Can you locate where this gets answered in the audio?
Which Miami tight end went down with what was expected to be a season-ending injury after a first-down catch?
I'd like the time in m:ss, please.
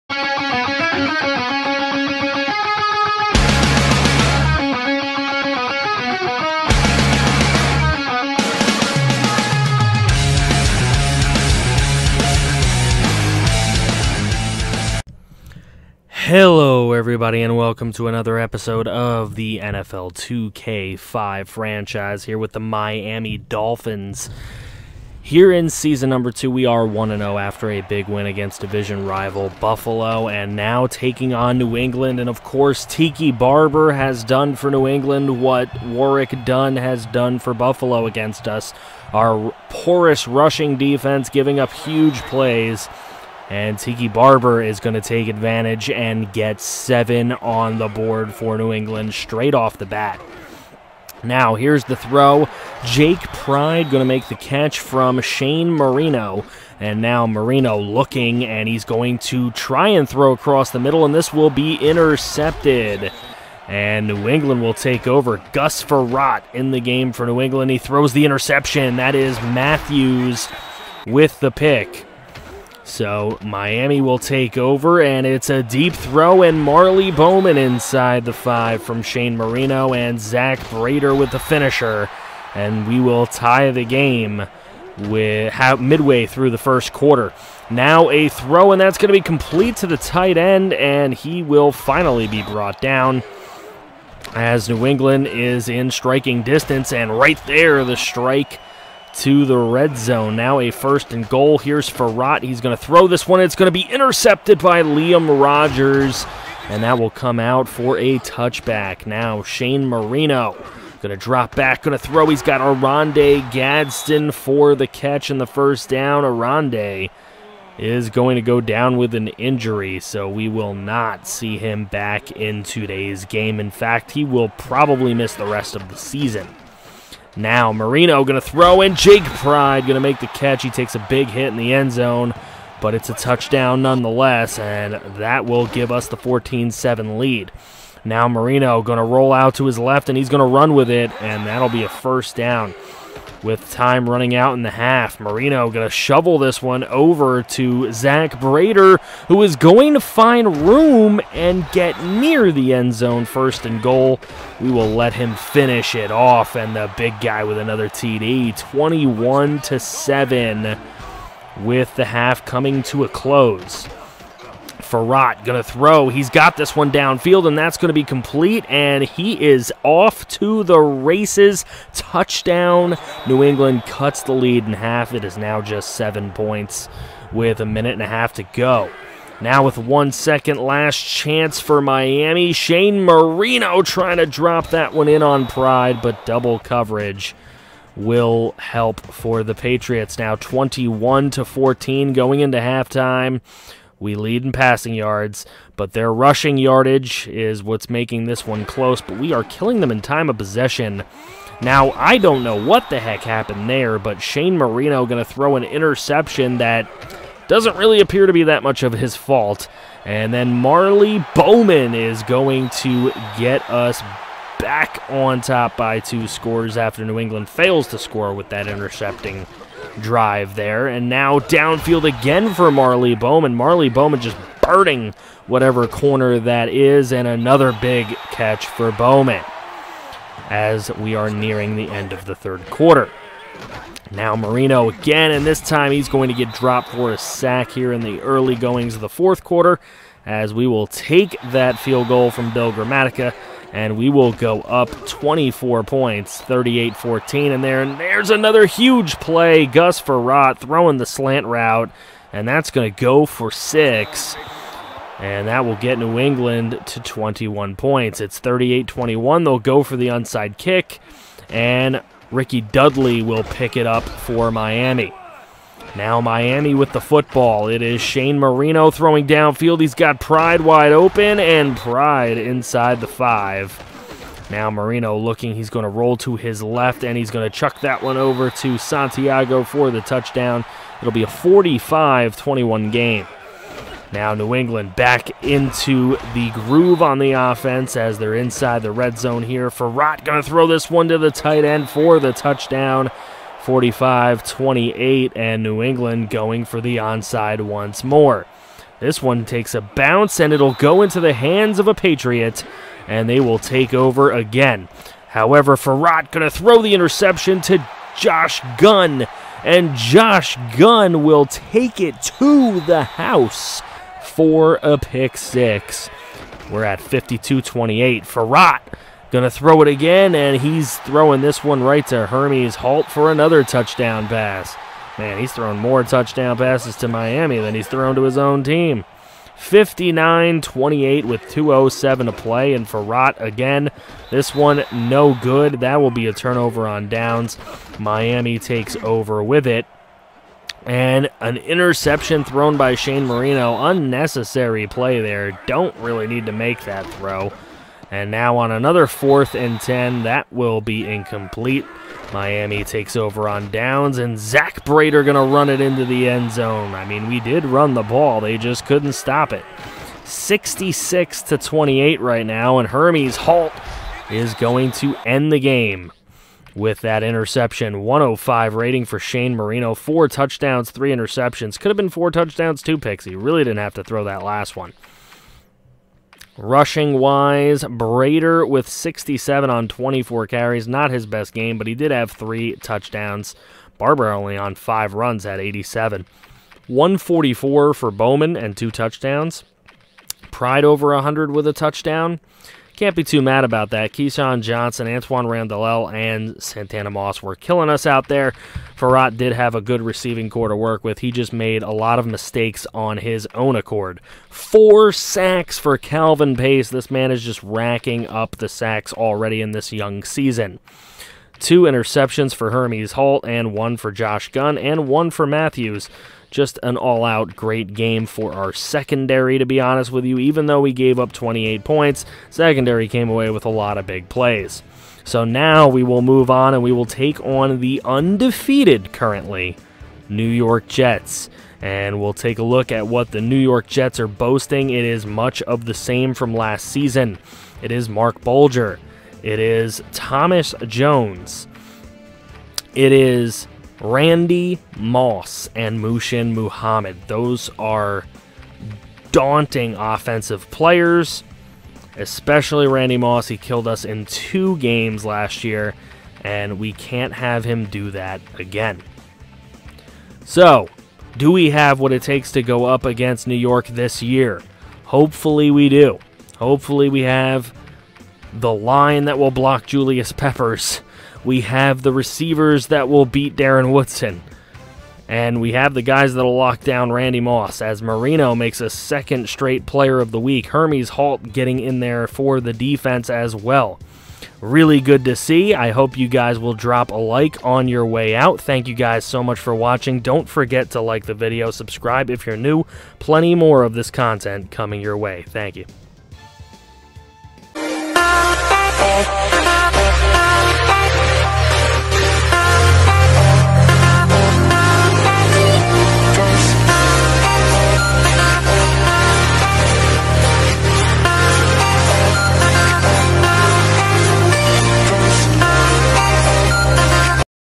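1:52.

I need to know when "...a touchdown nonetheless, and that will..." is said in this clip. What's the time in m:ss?
2:13.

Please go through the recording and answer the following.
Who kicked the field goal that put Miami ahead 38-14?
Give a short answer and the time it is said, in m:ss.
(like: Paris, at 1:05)
Bill Gramatica, at 4:02.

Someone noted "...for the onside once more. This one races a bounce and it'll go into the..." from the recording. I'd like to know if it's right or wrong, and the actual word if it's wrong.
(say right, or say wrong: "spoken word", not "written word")
wrong: "takes", not "races".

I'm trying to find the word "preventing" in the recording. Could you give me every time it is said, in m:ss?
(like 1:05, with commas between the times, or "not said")
not said.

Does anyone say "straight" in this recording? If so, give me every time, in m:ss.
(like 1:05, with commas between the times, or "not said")
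0:49, 7:59.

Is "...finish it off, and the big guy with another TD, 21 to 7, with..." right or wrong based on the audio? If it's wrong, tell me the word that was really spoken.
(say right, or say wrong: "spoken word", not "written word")
right.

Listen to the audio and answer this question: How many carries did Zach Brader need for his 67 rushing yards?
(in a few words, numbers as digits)
24.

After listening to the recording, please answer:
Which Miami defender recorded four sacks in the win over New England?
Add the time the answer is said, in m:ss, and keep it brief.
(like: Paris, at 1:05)
Calvin Pace, at 6:45.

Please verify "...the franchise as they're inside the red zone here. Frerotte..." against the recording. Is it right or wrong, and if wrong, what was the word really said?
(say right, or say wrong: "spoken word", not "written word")
wrong: "offense", not "franchise".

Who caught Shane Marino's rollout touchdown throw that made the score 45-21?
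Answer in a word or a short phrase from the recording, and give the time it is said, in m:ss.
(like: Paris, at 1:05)
Santiago, at 4:38.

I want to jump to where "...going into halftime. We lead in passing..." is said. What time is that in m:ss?
3:12.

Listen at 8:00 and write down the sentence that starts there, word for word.
Hermes Holt getting in there for the defense as well.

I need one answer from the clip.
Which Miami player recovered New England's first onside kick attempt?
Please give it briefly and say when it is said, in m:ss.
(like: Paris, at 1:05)
Rickey Dudley, at 4:22.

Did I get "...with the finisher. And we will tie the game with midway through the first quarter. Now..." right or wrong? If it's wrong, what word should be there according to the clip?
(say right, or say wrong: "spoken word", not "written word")
right.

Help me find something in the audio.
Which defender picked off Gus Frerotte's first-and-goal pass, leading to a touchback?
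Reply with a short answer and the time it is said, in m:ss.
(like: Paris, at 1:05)
Liam Rogers, at 1:44.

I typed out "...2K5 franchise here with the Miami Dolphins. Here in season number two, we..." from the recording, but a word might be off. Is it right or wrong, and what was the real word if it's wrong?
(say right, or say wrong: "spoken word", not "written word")
right.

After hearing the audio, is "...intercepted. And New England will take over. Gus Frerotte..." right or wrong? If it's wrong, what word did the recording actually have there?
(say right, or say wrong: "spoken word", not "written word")
right.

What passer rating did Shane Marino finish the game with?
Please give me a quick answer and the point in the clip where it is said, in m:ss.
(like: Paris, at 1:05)
105, at 6:08.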